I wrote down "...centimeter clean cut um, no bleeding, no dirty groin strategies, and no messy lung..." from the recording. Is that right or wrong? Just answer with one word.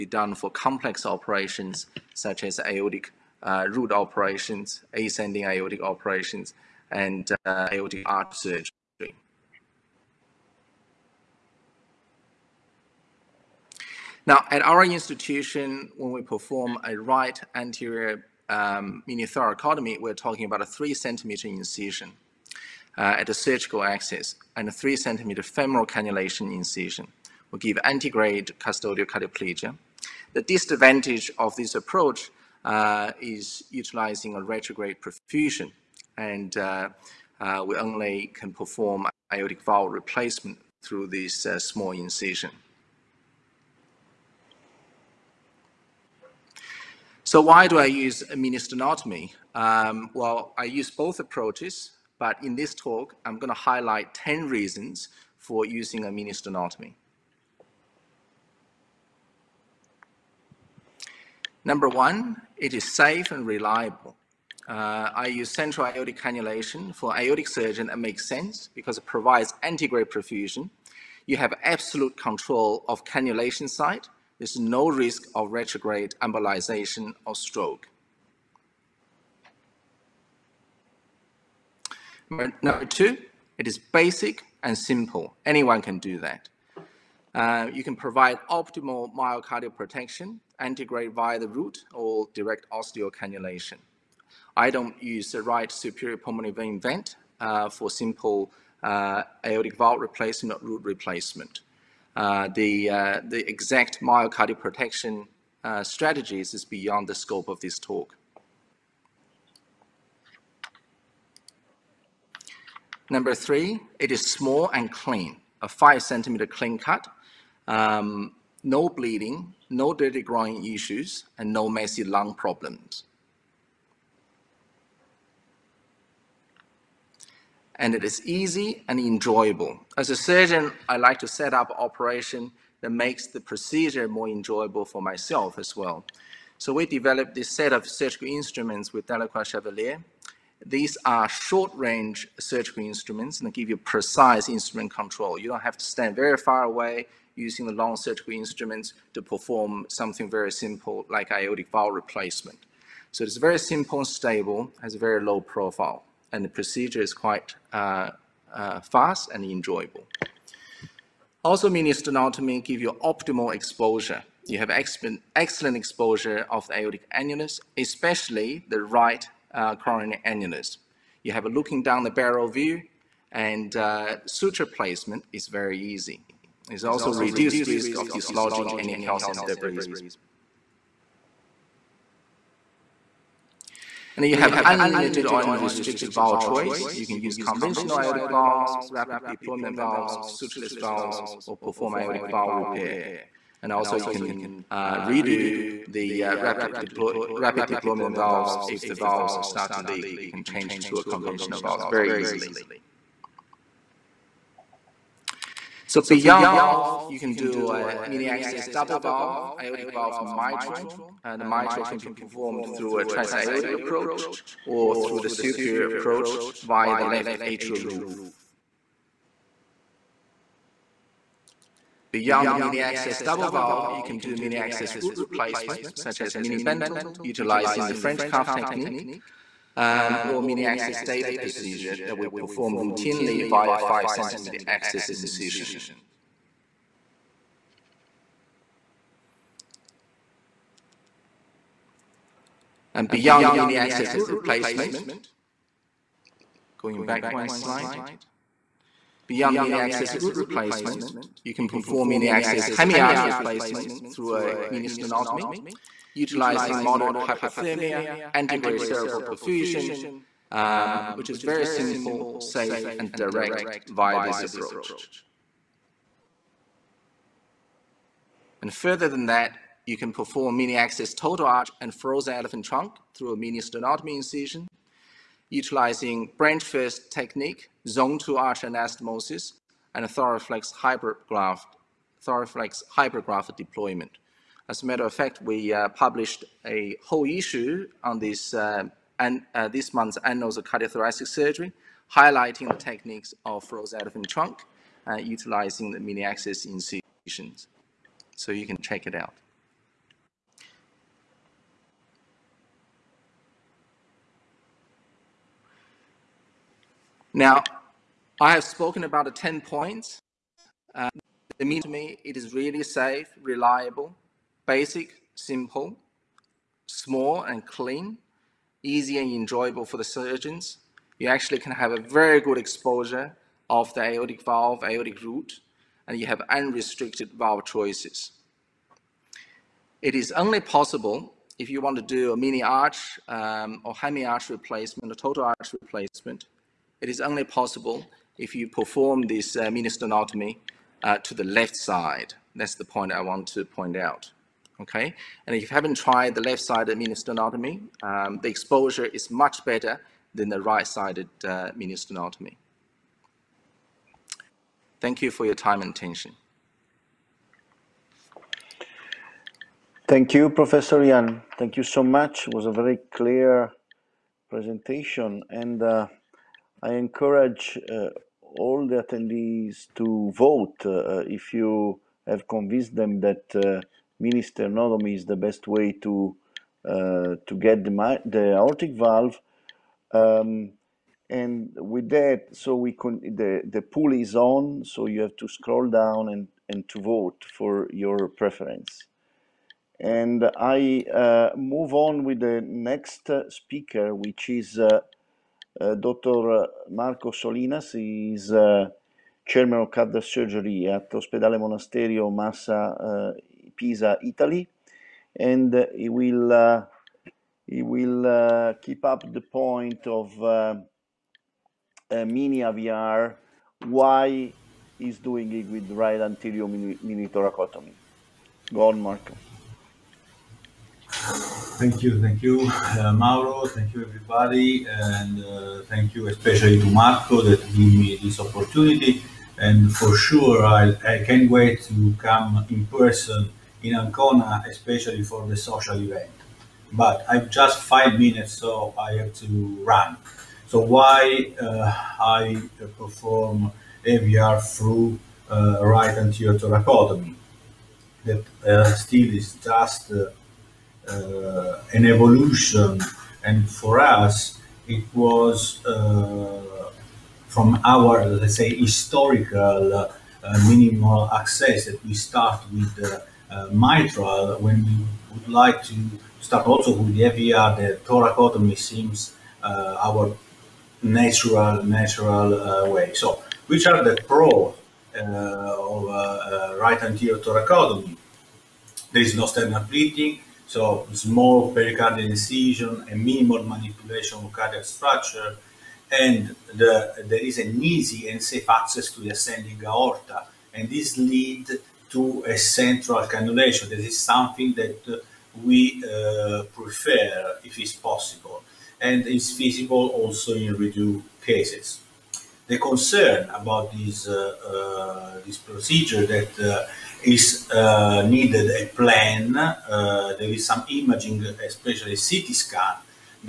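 wrong.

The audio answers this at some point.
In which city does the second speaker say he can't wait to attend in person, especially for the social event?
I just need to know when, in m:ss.
7:13.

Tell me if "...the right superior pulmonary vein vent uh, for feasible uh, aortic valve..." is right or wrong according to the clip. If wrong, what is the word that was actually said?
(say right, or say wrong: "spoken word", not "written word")
wrong: "simple", not "feasible".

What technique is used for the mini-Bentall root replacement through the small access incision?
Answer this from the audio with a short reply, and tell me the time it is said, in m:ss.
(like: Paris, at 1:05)
French cuff technique, at 3:47.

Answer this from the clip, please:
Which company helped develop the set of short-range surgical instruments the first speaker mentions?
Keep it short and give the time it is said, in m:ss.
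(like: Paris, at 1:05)
Delacroix Chevalier, at 2:19.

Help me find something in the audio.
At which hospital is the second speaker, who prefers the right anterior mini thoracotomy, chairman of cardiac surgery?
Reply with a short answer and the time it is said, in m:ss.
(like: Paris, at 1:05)
Ospedale Monasterio Massa, at 6:41.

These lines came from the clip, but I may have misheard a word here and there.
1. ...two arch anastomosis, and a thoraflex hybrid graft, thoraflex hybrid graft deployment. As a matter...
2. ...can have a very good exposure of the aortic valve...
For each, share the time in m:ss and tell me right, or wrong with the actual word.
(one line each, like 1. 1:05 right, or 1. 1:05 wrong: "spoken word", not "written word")
1. 4:38 right
2. 5:21 right.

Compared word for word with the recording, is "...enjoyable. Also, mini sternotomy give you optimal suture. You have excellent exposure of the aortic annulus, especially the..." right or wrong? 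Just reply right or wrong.
wrong.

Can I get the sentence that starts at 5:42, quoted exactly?
That's the point I want to point out okay?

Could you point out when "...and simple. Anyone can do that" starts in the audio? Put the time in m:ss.
1:24.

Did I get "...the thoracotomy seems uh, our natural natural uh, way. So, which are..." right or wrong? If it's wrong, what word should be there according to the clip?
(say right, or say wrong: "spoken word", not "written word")
right.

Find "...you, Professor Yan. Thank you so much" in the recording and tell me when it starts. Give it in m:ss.
6:00.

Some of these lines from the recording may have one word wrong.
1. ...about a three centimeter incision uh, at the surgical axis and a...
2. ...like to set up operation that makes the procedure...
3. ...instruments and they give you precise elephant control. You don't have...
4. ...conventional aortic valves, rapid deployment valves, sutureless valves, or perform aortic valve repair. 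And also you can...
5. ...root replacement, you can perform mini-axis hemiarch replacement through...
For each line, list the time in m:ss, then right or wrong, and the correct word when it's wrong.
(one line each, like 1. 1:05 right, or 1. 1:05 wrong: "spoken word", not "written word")
1. 0:20 right
2. 2:10 right
3. 2:22 wrong: "instrument", not "elephant"
4. 3:07 right
5. 4:10 right.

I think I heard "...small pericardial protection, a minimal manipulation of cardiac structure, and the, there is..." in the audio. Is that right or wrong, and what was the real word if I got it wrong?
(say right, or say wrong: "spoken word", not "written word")
wrong: "incision", not "protection".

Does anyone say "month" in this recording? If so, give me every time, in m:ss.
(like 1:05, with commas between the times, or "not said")
4:49.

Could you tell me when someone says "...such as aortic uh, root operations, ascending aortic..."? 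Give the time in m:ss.
0:02.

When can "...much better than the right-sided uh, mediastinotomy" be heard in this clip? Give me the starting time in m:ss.
5:49.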